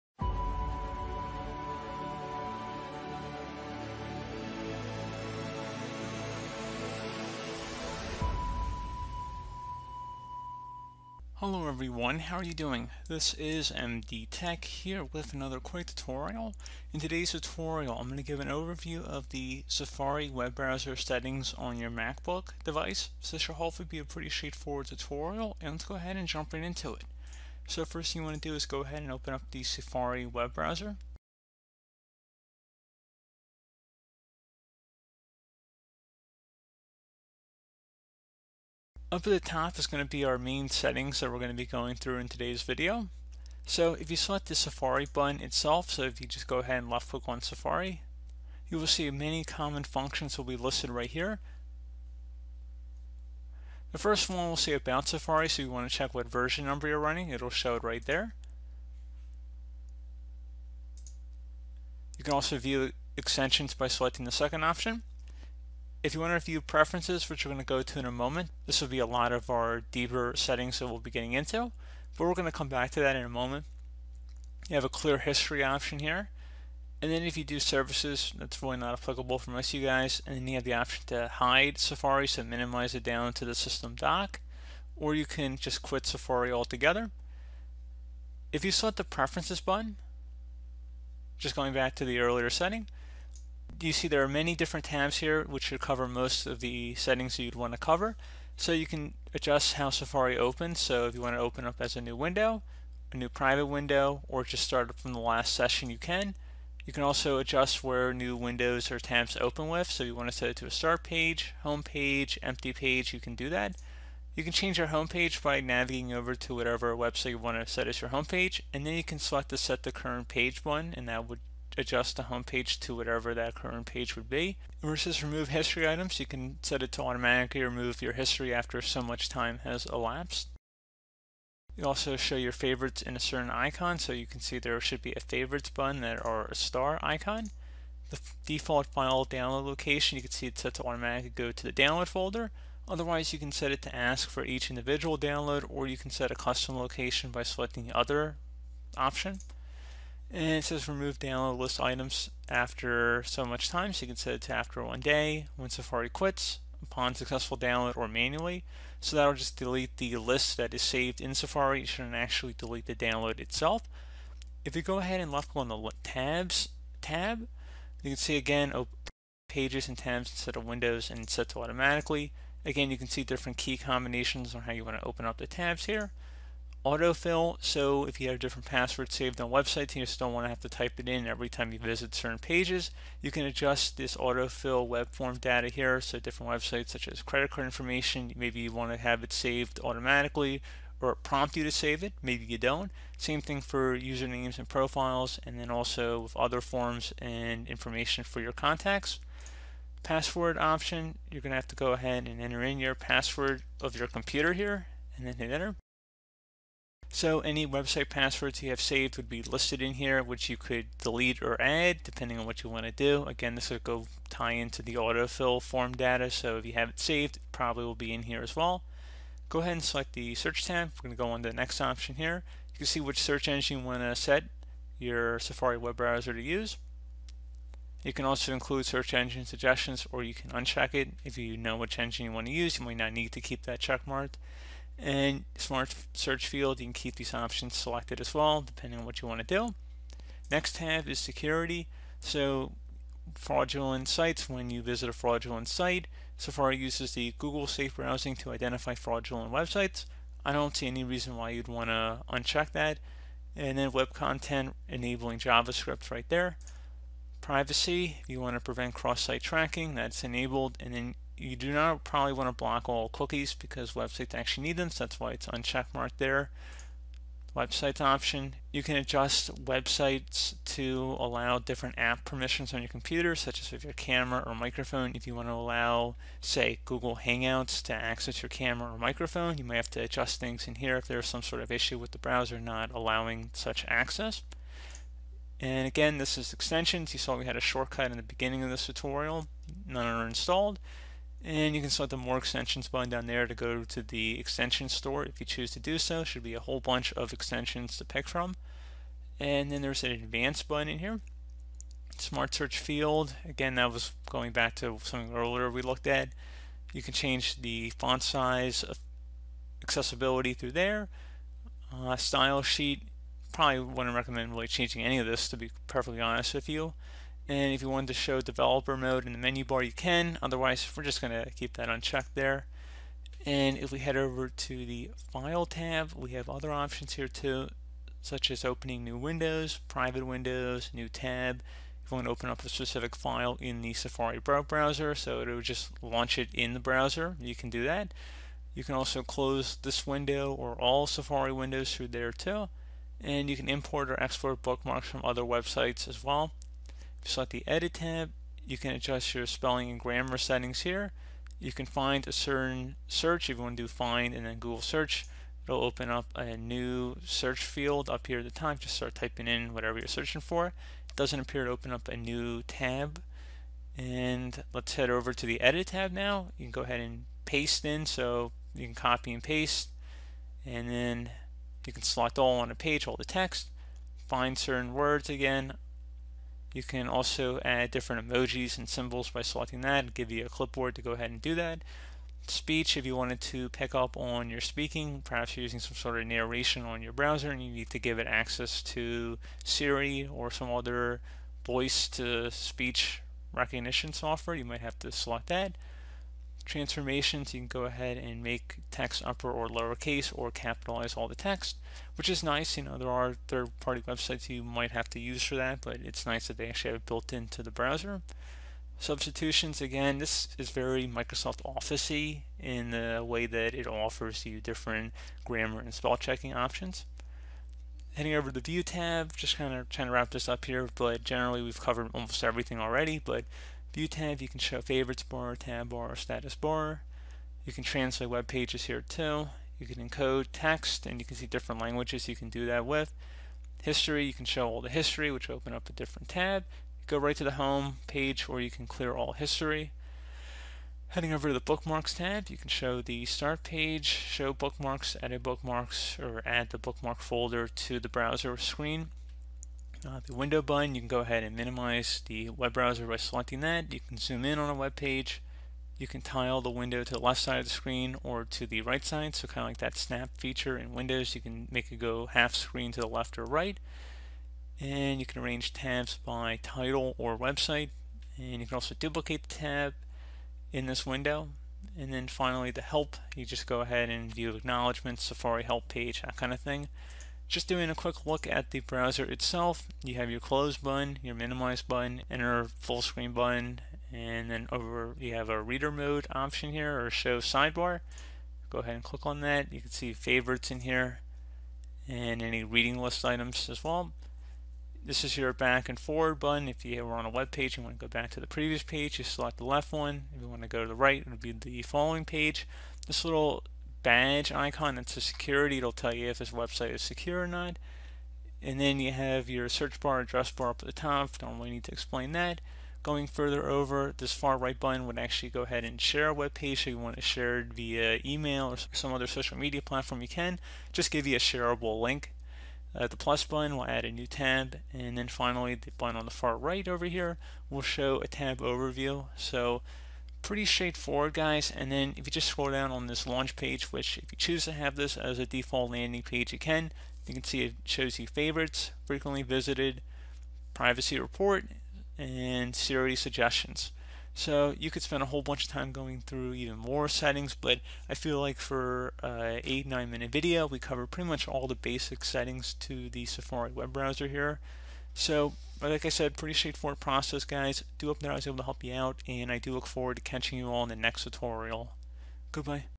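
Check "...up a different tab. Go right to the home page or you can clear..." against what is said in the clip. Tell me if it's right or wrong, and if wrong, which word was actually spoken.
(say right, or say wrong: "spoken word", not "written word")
right.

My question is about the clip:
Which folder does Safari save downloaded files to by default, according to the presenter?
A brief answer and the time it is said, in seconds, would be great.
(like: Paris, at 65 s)
download folder, at 141 s.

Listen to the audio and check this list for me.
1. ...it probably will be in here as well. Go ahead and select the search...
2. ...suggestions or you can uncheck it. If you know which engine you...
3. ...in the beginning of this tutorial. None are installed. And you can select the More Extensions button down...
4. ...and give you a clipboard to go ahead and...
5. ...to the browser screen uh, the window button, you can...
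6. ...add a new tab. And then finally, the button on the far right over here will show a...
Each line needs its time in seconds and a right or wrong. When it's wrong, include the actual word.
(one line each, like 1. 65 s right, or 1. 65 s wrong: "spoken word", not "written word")
1. 217 s right
2. 229 s right
3. 288 s right
4. 380 s right
5. 447 s right
6. 523 s right.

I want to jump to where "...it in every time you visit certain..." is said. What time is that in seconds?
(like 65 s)
180 s.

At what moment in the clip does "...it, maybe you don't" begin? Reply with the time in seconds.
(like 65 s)
192 s.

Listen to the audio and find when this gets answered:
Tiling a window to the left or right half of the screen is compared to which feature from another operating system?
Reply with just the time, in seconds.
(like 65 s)
459 s.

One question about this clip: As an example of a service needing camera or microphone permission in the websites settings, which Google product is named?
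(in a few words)
Google Hangouts.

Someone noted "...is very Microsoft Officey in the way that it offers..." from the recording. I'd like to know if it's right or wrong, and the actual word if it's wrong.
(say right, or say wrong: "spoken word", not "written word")
right.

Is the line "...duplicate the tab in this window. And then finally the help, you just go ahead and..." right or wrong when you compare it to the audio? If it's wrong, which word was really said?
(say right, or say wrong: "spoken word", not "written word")
right.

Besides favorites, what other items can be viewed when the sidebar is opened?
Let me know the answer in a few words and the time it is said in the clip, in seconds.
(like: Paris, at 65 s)
reading list items, at 492 s.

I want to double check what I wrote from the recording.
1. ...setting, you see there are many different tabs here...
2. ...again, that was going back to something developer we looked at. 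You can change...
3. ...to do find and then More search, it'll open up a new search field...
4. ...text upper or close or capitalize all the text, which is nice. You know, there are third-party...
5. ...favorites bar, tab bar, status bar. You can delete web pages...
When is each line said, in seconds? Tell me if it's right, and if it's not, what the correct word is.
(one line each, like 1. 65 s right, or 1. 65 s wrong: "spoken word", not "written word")
1. 92 s right
2. 303 s wrong: "earlier", not "developer"
3. 353 s wrong: "Google", not "More"
4. 398 s wrong: "lowercase", not "close"
5. 424 s wrong: "translate", not "delete".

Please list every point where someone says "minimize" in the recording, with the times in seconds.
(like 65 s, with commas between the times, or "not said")
82 s, 451 s, 481 s.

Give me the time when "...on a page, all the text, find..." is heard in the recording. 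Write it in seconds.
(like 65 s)
372 s.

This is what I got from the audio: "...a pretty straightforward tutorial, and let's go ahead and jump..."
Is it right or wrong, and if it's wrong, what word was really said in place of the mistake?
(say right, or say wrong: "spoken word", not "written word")
right.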